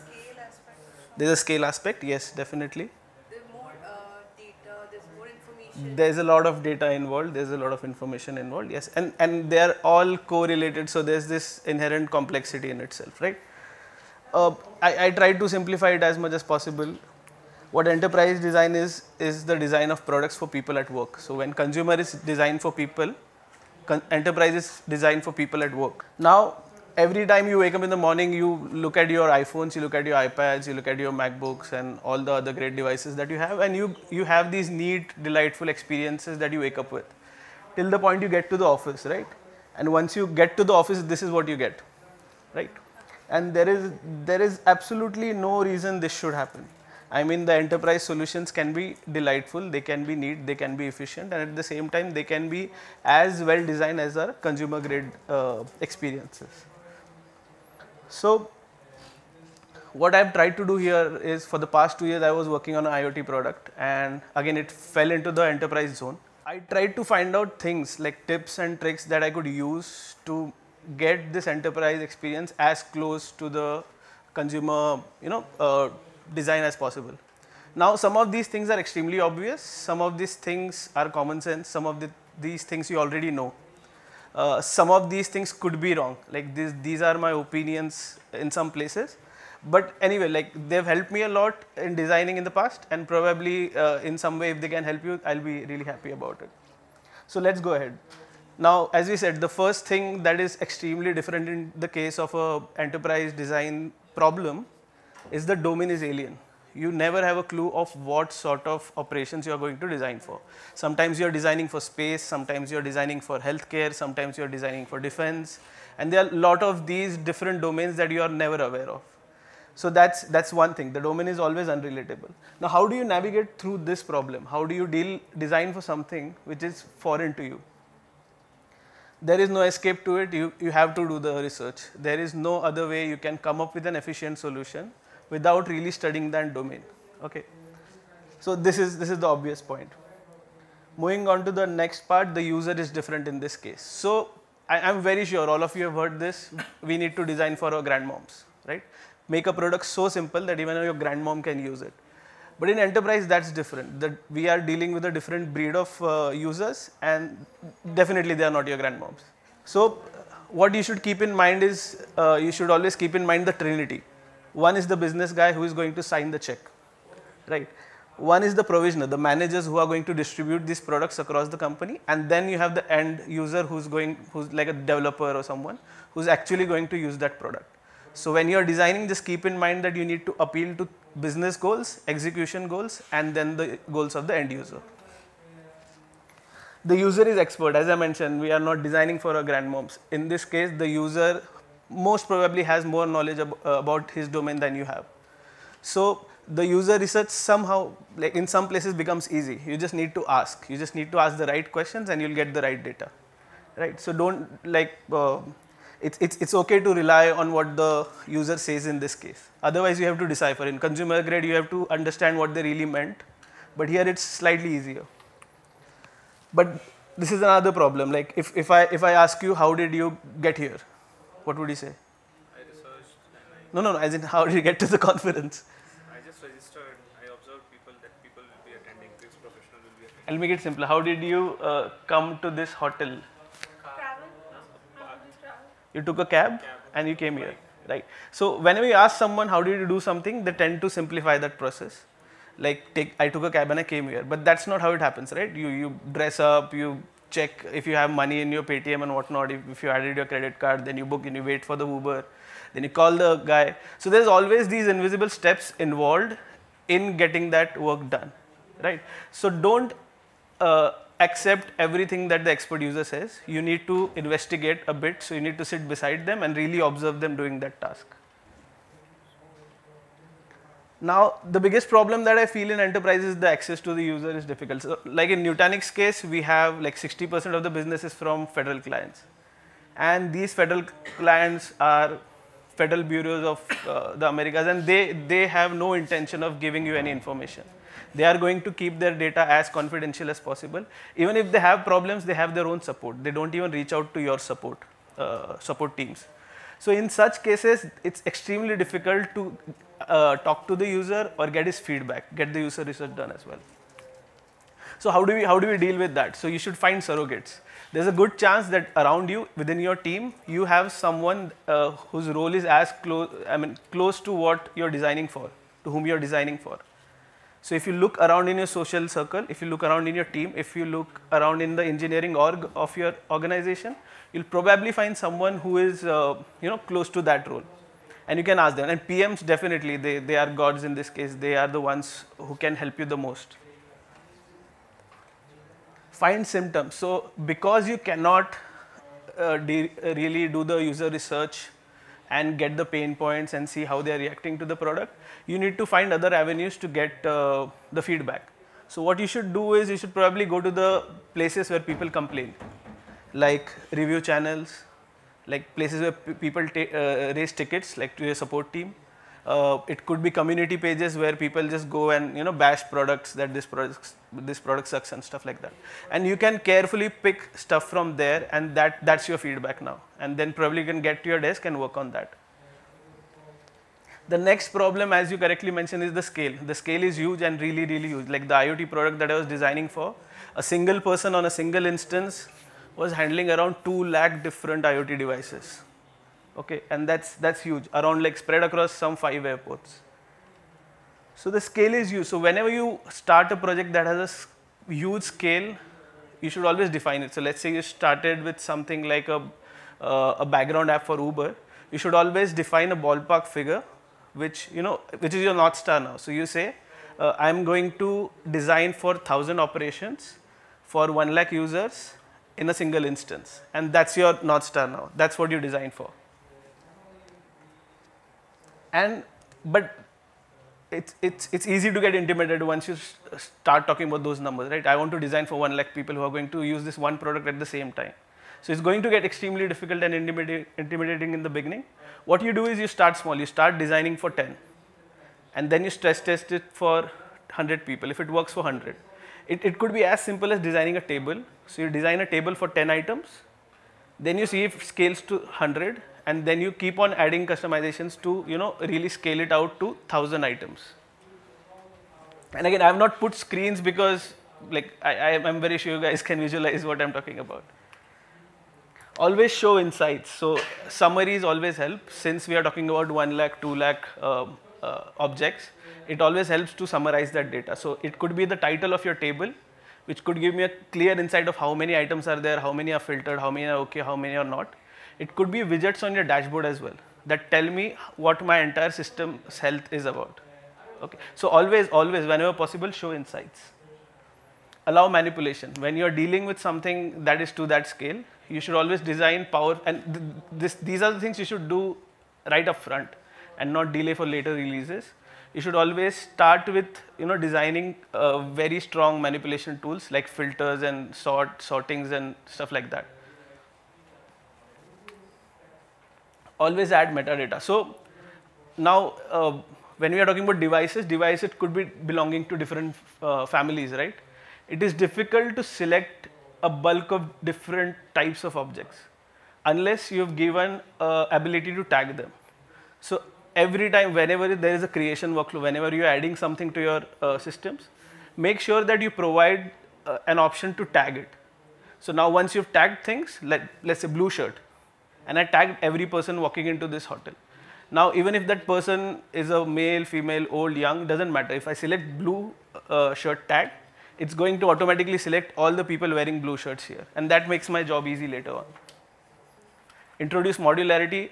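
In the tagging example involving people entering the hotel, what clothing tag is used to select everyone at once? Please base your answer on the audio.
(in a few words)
blue shirt.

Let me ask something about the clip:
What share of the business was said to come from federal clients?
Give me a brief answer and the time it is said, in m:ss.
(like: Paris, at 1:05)
60%, at 4:36.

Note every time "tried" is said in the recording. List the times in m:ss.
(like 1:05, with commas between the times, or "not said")
0:15, 1:00, 1:06.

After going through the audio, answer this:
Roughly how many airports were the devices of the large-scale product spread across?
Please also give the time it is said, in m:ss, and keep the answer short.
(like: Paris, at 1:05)
5, at 6:29.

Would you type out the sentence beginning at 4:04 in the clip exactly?
But that's not how it happens, right?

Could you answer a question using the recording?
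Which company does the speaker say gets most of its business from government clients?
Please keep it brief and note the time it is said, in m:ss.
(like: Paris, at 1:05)
Nutanix, at 4:35.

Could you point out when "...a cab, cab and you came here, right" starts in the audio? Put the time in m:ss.
3:56.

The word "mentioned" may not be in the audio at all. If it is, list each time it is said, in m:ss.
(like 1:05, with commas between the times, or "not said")
3:07, 6:15.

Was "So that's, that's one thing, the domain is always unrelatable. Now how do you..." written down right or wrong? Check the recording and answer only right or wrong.
right.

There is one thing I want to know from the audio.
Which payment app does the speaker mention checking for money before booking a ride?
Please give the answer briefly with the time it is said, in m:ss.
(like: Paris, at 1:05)
Paytm, at 4:08.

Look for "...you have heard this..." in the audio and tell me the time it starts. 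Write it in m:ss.
2:25.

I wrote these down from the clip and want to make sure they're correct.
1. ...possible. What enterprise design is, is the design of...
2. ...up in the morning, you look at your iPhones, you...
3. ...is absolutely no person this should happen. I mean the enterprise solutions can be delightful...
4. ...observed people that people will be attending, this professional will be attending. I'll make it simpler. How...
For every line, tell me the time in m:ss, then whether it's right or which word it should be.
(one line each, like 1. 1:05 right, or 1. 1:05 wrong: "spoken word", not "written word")
1. 0:16 right
2. 0:27 right
3. 0:44 wrong: "reason", not "person"
4. 3:47 right.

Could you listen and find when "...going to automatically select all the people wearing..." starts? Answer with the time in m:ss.
9:04.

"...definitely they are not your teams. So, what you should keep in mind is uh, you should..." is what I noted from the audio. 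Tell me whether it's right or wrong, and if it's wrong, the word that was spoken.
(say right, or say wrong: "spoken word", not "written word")
wrong: "grandmoms", not "teams".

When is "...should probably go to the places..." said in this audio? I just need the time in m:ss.
5:49.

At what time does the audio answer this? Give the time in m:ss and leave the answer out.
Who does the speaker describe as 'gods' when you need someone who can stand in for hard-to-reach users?
5:29.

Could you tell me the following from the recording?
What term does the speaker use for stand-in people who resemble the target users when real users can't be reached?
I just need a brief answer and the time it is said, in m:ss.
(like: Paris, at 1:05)
surrogates, at 5:07.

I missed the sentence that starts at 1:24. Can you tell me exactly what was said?
Uh, some of these things could be wrong.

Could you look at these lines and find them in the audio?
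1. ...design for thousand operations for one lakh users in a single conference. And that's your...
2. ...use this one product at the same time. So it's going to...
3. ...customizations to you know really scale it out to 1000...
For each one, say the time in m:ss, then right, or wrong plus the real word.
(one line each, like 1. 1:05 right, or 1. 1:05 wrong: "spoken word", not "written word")
1. 6:48 wrong: "instance", not "conference"
2. 7:06 right
3. 7:27 right.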